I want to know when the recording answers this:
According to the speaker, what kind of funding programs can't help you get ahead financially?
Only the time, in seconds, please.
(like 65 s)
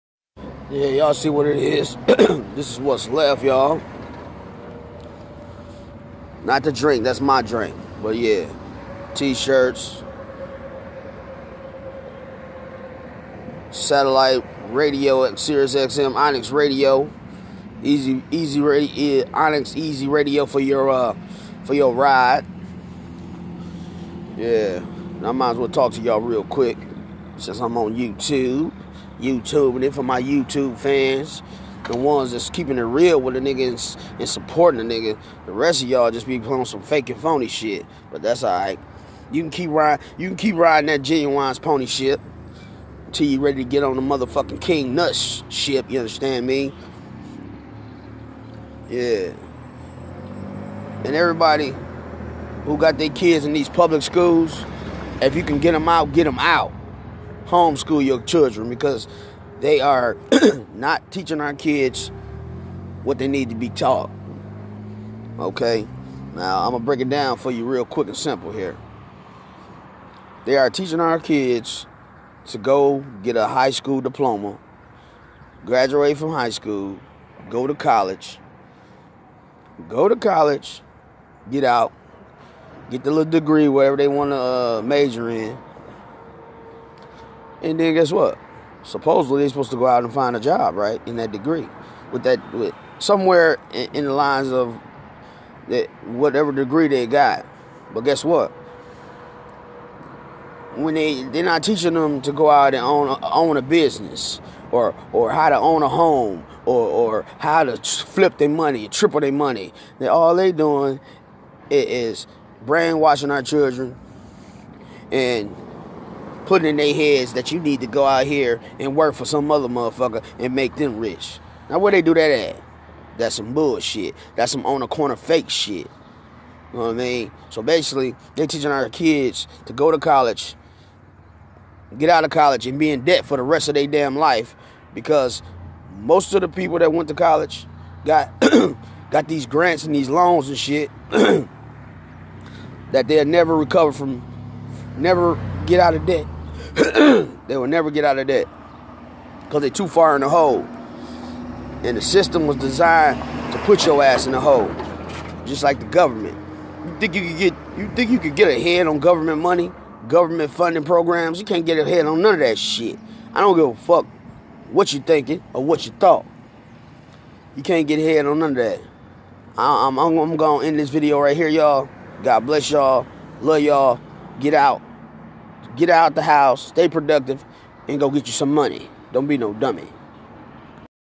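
160 s.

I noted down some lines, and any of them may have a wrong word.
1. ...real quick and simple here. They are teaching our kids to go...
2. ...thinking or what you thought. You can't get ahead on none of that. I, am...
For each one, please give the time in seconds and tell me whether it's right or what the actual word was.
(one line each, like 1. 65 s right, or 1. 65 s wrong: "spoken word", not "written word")
1. 67 s right
2. 165 s right.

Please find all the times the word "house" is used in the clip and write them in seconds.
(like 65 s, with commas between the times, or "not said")
176 s.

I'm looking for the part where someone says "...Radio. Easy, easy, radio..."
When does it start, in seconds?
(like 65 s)
16 s.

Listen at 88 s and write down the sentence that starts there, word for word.
Supposedly they're supposed to go out and find a job, right?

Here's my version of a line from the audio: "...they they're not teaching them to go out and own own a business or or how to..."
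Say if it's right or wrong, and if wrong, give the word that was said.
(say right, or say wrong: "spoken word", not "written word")
right.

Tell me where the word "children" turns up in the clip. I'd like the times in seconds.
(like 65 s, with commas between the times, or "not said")
58 s, 113 s.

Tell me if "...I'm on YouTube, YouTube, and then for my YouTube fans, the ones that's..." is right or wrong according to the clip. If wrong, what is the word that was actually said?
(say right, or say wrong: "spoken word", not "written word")
right.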